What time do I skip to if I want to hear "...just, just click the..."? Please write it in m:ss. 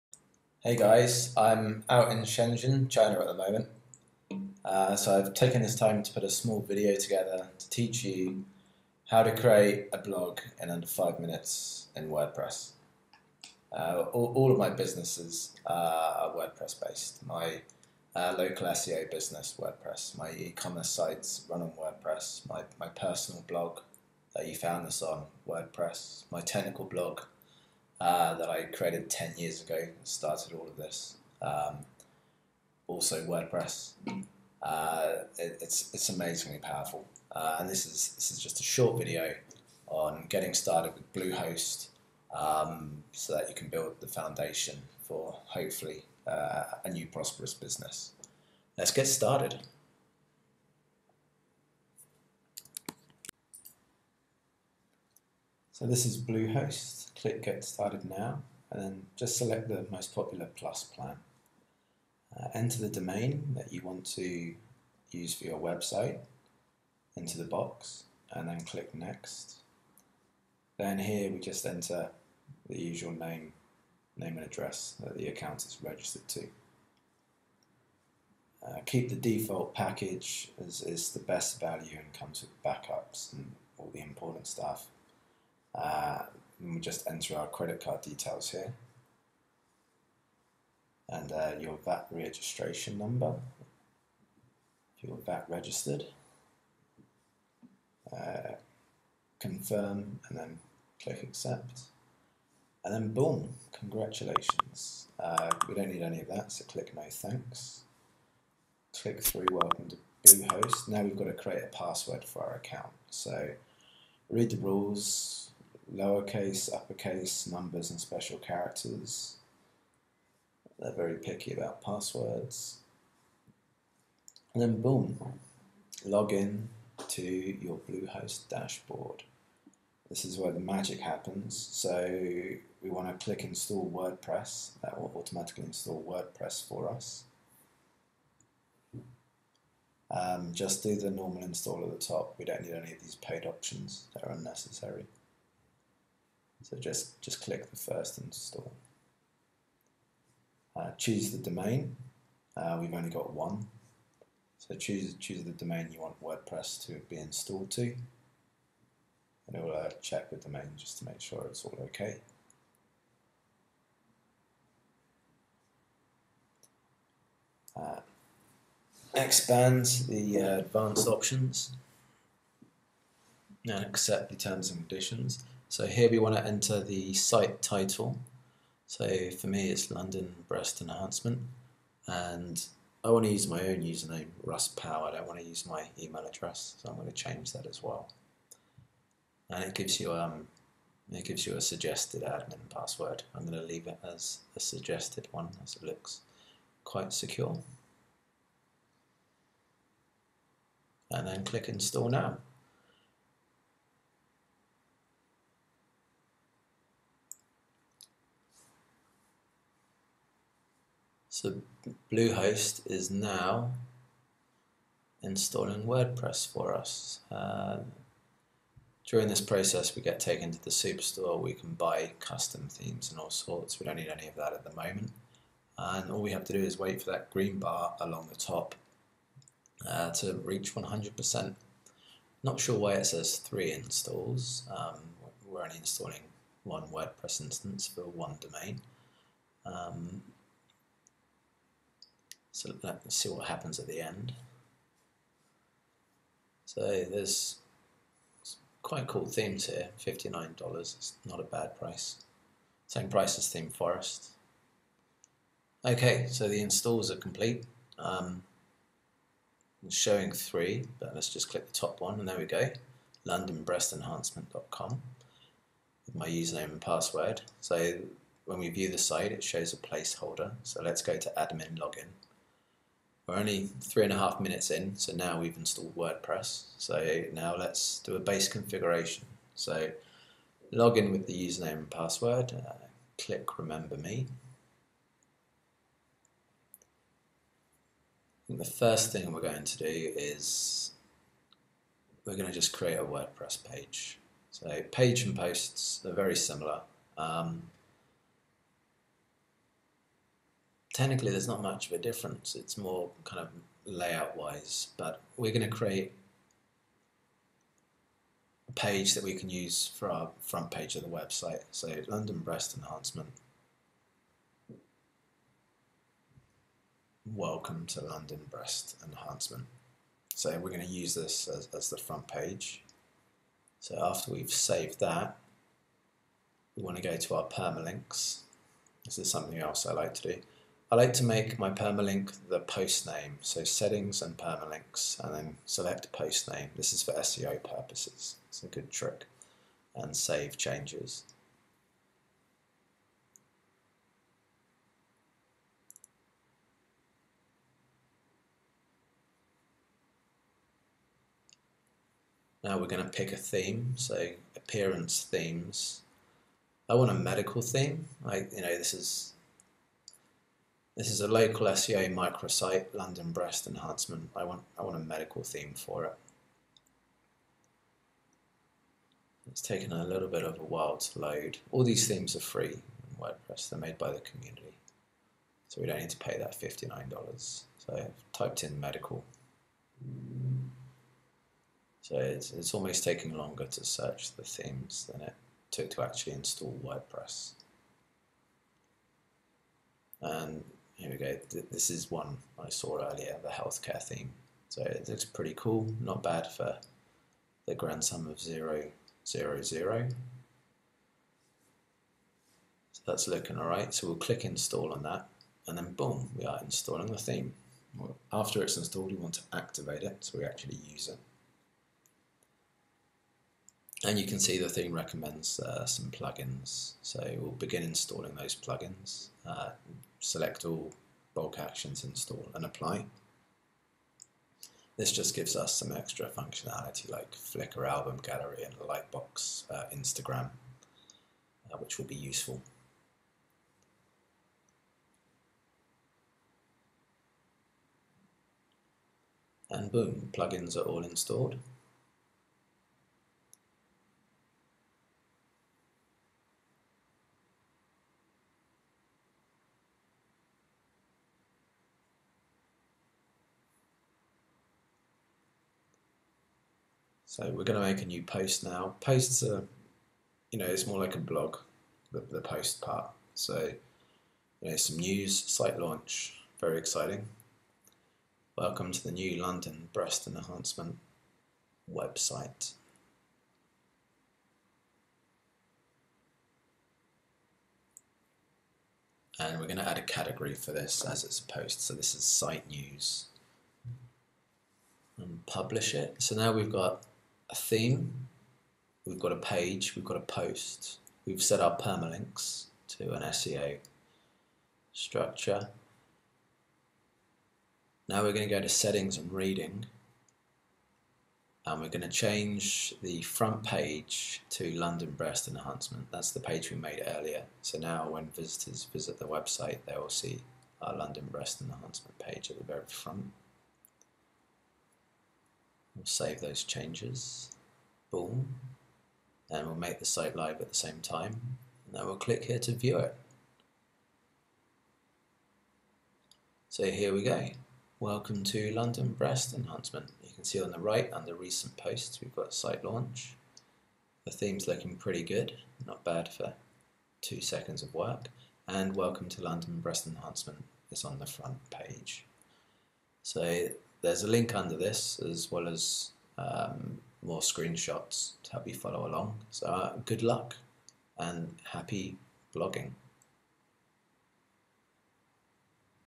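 2:26.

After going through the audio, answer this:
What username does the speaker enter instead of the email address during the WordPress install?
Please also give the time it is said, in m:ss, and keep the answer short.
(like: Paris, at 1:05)
Russ Power, at 3:04.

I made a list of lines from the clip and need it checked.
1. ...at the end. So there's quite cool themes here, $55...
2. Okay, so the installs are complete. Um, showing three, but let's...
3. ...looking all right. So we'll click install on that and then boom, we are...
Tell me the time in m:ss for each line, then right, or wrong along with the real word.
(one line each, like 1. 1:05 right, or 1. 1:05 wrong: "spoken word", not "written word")
1. 4:03 wrong: "59", not "55"
2. 4:15 right
3. 6:43 right.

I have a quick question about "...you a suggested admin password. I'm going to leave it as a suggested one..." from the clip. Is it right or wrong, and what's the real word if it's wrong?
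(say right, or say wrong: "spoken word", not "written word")
right.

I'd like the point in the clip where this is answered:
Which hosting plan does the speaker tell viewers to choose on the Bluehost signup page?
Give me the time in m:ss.
1:00.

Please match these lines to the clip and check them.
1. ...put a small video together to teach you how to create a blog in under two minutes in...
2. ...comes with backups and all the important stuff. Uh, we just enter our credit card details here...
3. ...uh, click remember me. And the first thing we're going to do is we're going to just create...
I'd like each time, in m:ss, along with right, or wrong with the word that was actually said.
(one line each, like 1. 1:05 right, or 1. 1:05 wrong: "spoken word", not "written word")
1. 0:06 wrong: "five", not "two"
2. 1:22 right
3. 4:42 right.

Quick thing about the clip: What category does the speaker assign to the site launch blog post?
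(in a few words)
Site news.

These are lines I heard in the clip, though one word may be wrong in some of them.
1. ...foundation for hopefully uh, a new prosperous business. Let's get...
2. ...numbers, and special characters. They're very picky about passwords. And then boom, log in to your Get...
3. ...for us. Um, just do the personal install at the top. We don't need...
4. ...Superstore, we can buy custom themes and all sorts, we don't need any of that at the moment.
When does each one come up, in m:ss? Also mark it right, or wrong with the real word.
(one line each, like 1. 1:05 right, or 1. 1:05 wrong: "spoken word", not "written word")
1. 0:44 right
2. 1:57 wrong: "Bluehost", not "Get"
3. 2:16 wrong: "normal", not "personal"
4. 3:40 right.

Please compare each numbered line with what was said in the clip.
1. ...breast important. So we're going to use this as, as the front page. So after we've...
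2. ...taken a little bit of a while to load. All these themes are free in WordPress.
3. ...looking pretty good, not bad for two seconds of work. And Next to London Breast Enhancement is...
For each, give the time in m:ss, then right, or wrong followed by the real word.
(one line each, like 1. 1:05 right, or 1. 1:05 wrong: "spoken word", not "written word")
1. 5:18 wrong: "enhancement", not "important"
2. 6:09 right
3. 8:54 wrong: "Welcome", not "Next".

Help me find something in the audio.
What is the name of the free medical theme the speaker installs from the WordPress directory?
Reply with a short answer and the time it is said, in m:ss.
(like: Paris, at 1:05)
Healthcare, at 6:33.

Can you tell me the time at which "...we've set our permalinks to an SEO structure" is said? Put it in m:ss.
8:11.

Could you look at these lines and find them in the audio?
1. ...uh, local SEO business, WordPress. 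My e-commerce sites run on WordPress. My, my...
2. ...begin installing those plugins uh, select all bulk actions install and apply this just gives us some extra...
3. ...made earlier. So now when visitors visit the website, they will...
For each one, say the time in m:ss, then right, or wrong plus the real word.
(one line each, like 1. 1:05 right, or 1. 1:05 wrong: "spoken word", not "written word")
1. 0:18 right
2. 6:57 right
3. 8:26 right.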